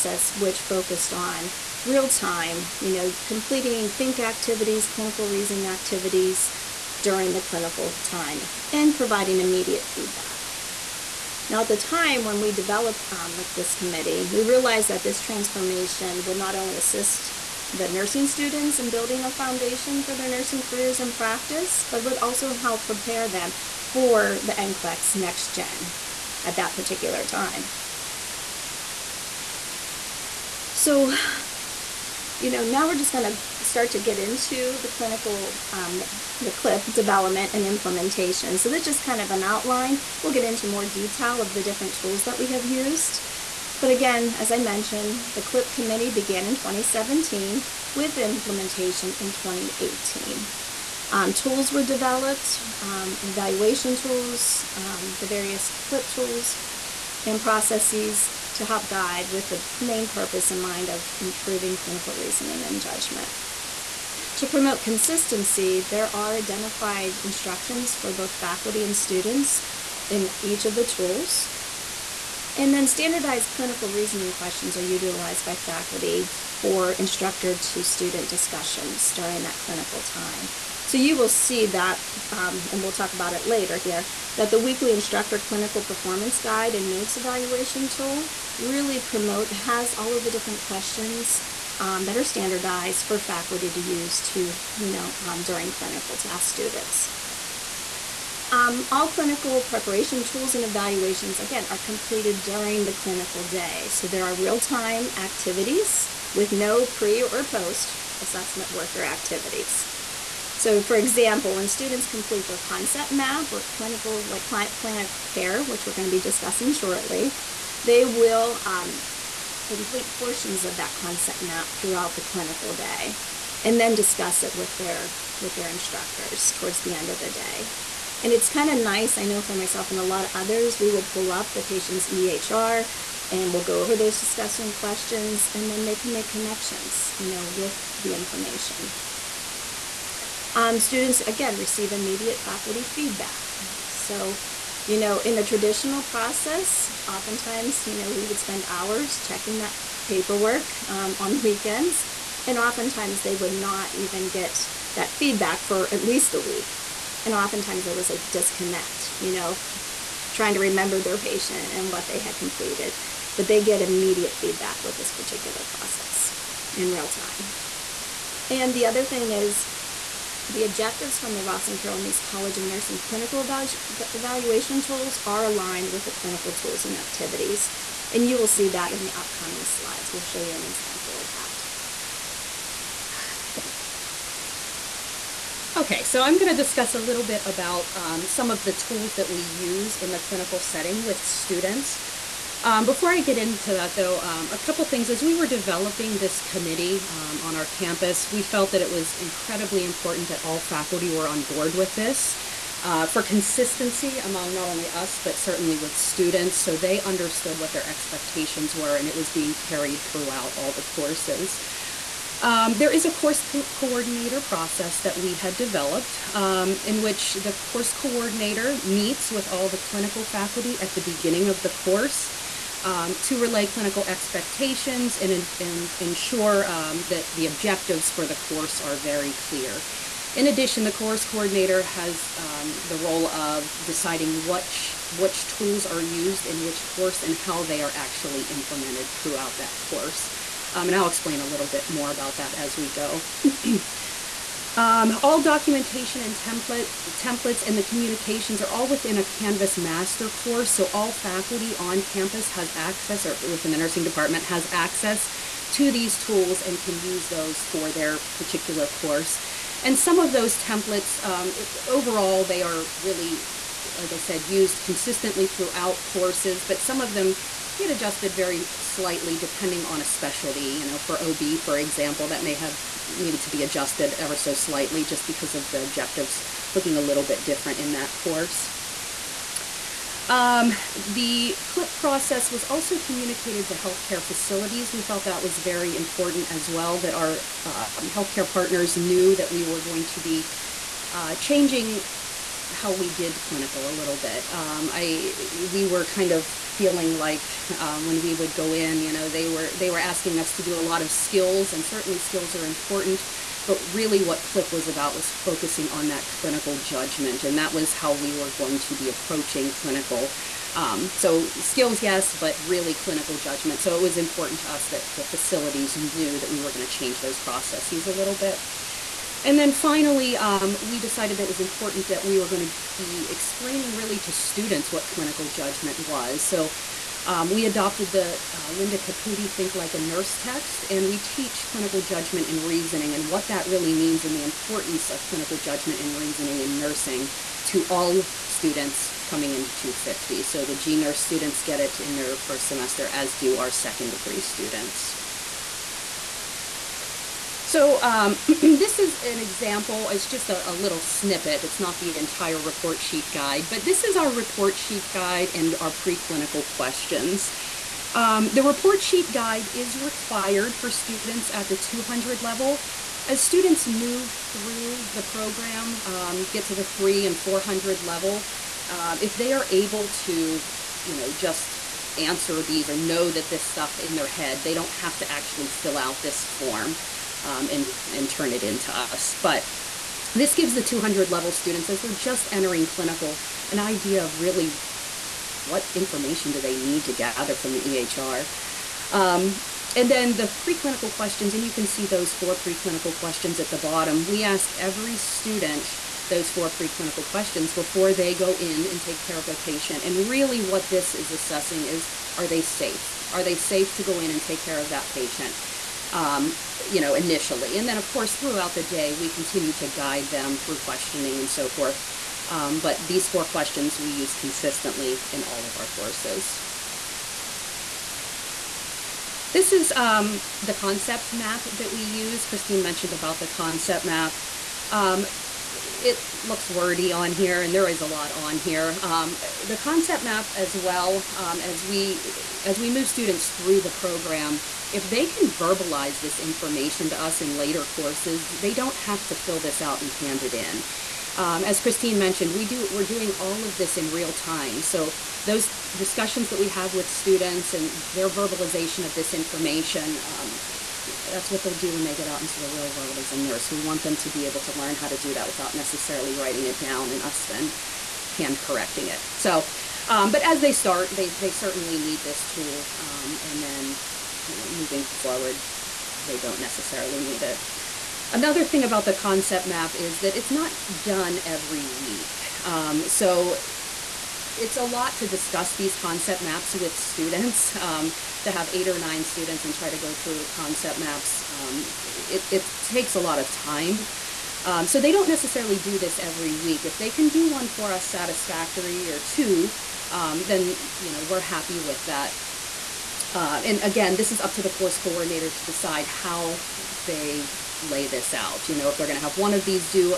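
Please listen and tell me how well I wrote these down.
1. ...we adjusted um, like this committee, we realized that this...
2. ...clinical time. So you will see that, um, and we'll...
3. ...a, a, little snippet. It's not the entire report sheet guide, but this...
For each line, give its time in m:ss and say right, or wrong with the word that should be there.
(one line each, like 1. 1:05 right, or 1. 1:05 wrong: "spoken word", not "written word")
1. 0:12 wrong: "developed", not "adjusted"
2. 1:19 right
3. 5:50 right.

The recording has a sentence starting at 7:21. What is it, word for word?
Um, as Christine mentioned, we do we're doing all of this in real time.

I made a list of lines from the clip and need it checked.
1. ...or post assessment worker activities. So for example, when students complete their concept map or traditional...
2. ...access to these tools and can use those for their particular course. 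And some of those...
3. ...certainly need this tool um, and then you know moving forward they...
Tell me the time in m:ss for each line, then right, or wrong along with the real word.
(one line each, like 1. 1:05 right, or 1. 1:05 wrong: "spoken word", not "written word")
1. 1:47 wrong: "clinical", not "traditional"
2. 4:14 right
3. 7:41 right.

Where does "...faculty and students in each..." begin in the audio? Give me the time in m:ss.
1:08.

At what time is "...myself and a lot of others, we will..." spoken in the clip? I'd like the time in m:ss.
2:09.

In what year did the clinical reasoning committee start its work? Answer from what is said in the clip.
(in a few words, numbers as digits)
2017.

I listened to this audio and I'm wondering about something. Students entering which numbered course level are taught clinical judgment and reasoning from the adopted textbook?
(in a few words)
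250.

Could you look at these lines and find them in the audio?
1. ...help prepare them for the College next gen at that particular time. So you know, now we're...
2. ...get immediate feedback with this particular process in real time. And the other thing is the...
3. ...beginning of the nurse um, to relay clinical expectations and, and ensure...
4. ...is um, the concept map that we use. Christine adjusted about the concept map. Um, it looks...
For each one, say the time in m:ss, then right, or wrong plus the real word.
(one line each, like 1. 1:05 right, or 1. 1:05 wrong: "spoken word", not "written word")
1. 0:22 wrong: "NCLEX", not "College"
2. 2:43 right
3. 3:41 wrong: "course", not "nurse"
4. 6:59 wrong: "mentioned", not "adjusted".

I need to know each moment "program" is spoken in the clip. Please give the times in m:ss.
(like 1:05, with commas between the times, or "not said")
6:05, 7:13.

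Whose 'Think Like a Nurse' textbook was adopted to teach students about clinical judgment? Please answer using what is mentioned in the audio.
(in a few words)
Linda Caputi.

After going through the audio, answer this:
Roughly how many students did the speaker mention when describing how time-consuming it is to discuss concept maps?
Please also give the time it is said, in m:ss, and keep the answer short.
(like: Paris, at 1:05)
8 or 9, at 7:58.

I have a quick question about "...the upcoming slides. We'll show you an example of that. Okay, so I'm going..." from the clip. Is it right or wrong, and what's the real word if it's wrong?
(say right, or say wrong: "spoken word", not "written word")
right.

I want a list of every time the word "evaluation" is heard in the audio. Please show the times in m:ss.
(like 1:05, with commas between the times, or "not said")
0:53, 1:27, 1:40, 2:54.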